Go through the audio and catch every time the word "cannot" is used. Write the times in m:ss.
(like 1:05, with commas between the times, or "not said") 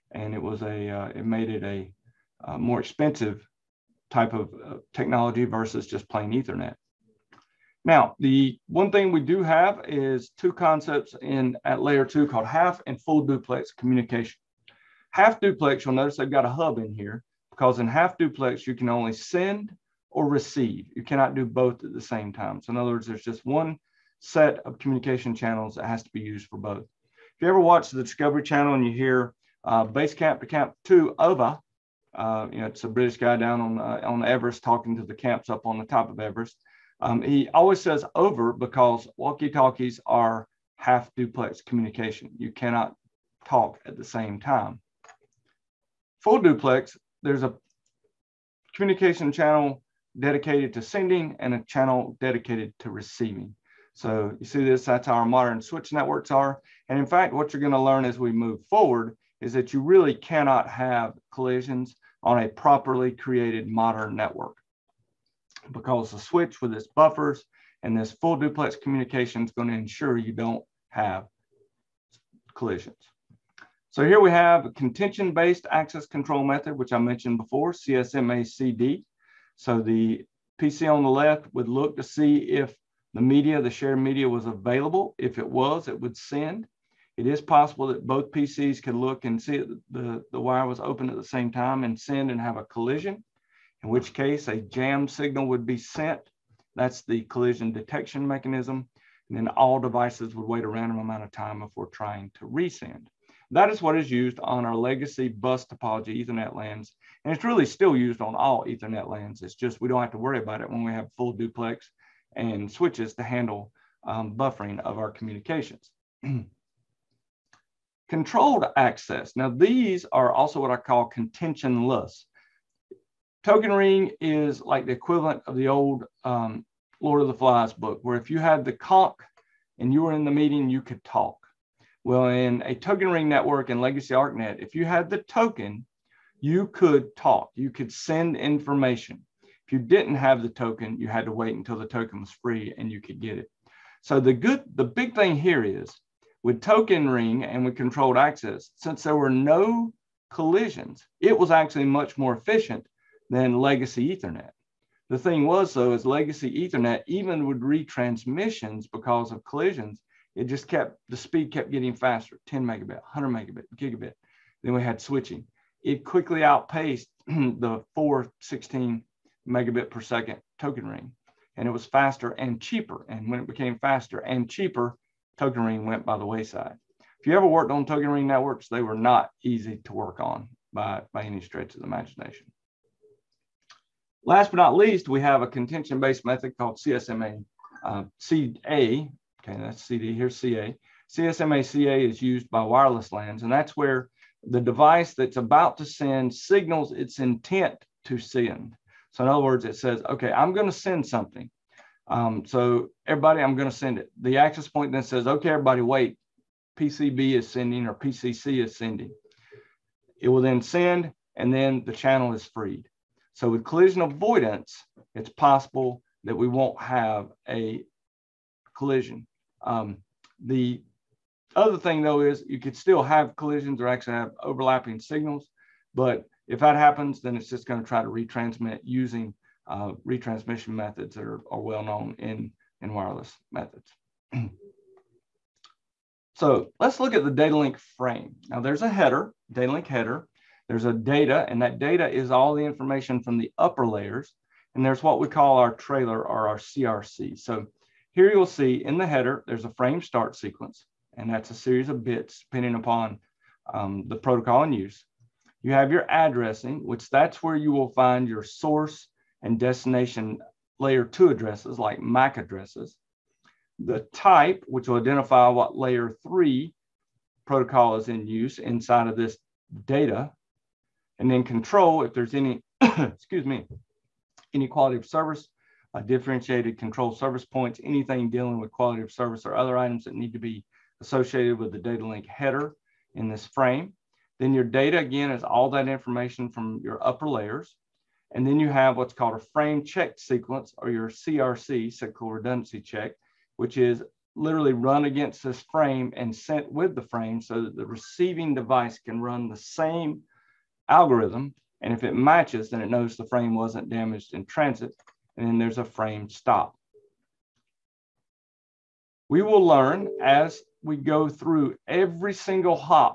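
0:21, 0:42, 1:00.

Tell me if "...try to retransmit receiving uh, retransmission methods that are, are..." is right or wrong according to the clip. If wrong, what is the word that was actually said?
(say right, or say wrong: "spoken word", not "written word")
wrong: "using", not "receiving".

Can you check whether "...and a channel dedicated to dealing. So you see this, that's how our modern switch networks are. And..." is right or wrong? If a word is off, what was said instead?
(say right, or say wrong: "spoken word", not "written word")
wrong: "receiving", not "dealing".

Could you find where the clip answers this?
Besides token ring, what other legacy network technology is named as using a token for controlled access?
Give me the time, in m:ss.
2:14.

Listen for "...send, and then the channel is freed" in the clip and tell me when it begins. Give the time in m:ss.
3:30.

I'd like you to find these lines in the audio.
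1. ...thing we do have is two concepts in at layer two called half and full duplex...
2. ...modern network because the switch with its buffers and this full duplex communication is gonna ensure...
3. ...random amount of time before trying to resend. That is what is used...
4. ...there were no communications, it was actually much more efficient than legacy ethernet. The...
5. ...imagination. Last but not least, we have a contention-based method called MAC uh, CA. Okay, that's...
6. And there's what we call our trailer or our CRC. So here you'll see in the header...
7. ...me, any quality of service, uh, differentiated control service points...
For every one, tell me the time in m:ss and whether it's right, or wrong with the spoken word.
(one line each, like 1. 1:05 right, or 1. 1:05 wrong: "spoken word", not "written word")
1. 0:08 right
2. 1:03 right
3. 1:40 right
4. 2:29 wrong: "collisions", not "communications"
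5. 3:01 wrong: "CSMA", not "MAC"
6. 4:04 right
7. 4:33 right.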